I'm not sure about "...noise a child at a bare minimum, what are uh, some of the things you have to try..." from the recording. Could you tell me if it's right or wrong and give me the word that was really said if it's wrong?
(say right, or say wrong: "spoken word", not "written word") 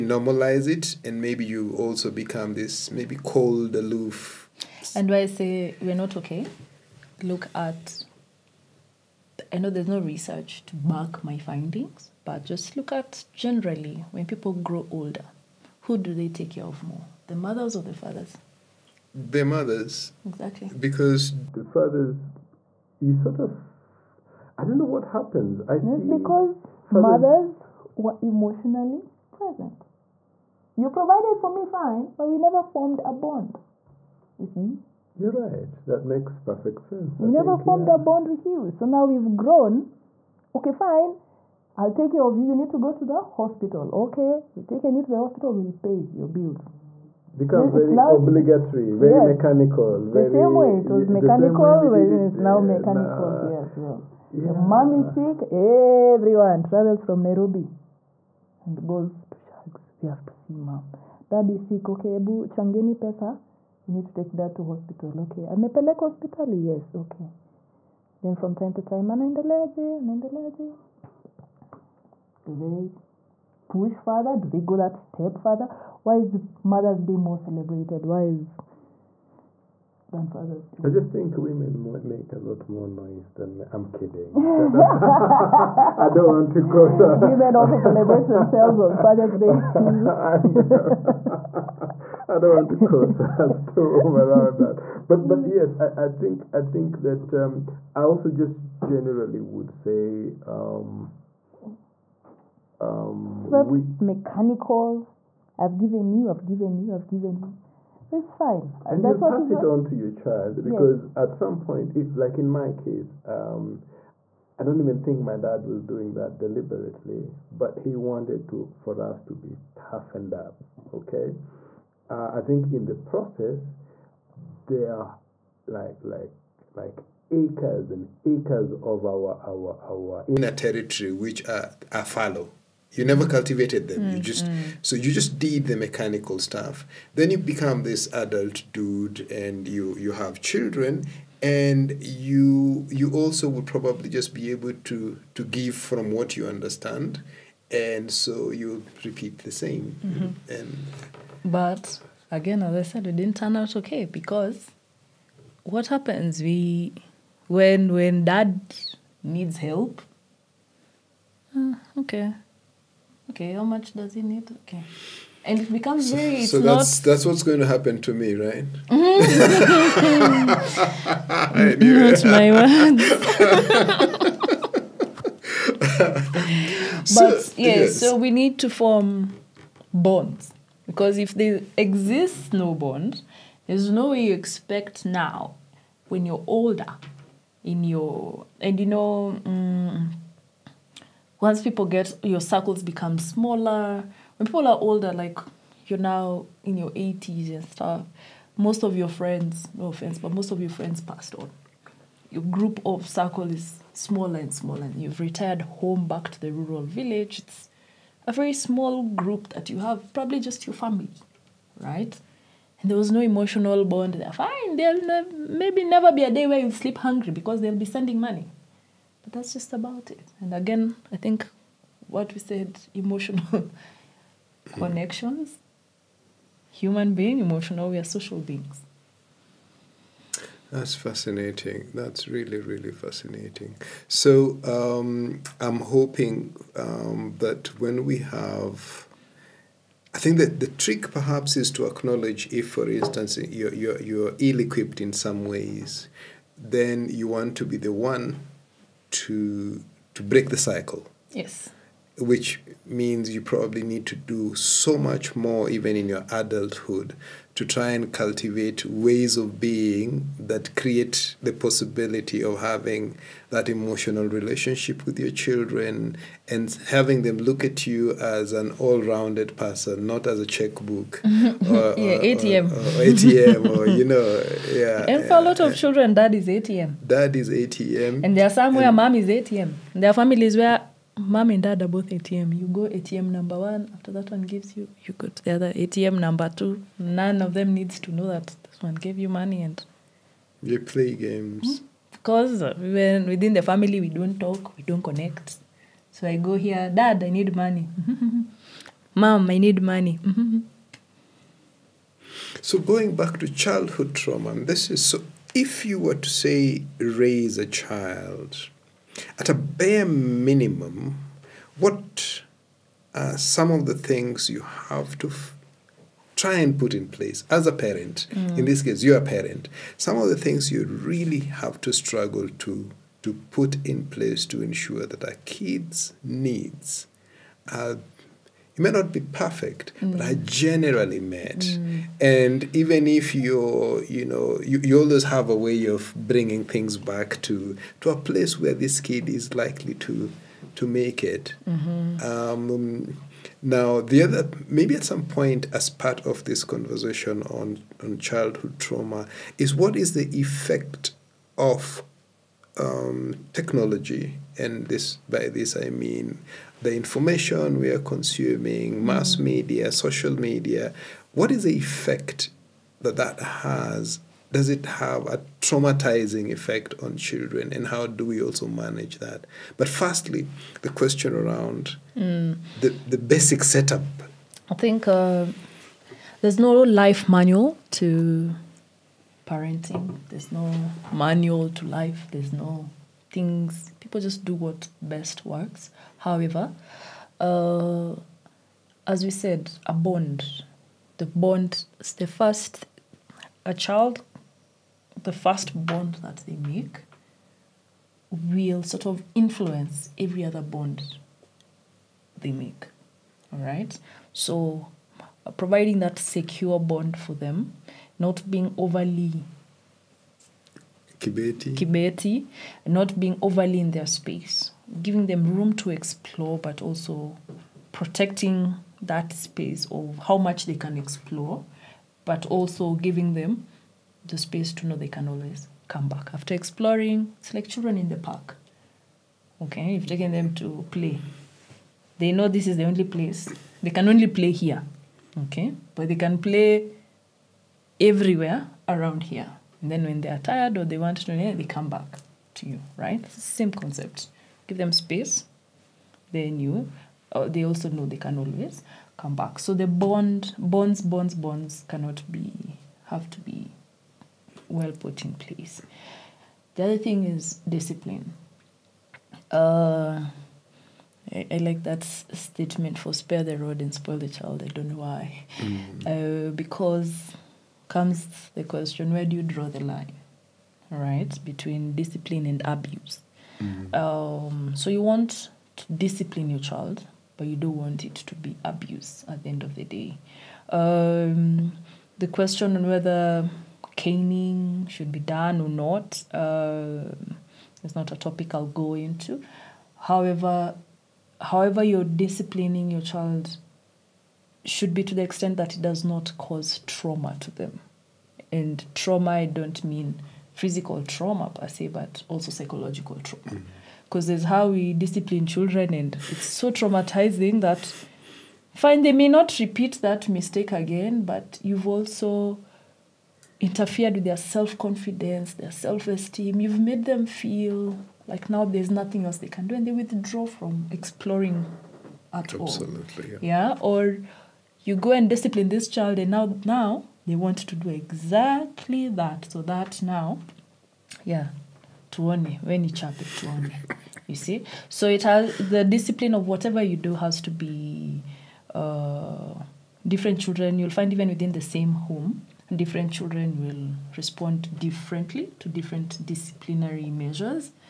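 wrong: "raise", not "noise".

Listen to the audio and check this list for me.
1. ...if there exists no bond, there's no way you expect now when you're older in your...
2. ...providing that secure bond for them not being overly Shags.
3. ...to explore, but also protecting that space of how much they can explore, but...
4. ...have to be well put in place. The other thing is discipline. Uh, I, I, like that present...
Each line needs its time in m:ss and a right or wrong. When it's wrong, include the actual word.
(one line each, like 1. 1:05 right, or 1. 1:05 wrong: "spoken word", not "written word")
1. 3:01 right
2. 6:45 wrong: "Kibeti", not "Shags"
3. 6:55 right
4. 7:33 wrong: "statement", not "present".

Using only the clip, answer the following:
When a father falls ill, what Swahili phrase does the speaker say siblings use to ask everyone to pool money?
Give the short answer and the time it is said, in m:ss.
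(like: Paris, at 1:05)
ebu changeni pesa, at 1:02.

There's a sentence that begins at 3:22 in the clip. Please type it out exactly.
Your group of circle is smaller and smaller, and you've retired home back to the rural village.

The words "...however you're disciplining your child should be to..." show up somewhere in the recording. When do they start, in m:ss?
8:11.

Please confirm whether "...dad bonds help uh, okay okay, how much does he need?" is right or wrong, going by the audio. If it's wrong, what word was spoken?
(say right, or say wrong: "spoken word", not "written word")
wrong: "needs", not "bonds".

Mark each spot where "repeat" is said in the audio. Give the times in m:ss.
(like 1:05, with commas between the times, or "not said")
2:29, 8:29.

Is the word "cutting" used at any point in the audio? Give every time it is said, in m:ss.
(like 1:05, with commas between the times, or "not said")
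not said.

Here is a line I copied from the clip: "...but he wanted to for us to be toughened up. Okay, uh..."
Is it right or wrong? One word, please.
right.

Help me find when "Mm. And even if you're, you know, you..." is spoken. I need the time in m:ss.
5:31.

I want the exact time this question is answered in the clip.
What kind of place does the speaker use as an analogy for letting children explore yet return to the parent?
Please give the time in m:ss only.
7:08.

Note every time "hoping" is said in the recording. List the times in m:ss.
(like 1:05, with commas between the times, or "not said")
3:55.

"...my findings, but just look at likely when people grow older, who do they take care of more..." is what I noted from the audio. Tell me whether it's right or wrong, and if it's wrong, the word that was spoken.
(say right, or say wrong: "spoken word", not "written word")
wrong: "generally", not "likely".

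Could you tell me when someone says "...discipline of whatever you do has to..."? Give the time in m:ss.
8:55.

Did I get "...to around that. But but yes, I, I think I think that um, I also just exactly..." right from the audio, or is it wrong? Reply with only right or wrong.
wrong.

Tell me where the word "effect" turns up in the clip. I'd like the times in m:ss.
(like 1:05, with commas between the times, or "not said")
5:50, 6:01, 6:06.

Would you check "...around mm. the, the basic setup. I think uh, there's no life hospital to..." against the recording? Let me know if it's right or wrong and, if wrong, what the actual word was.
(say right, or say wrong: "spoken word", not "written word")
wrong: "manual", not "hospital".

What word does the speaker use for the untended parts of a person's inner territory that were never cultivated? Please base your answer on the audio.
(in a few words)
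fallow.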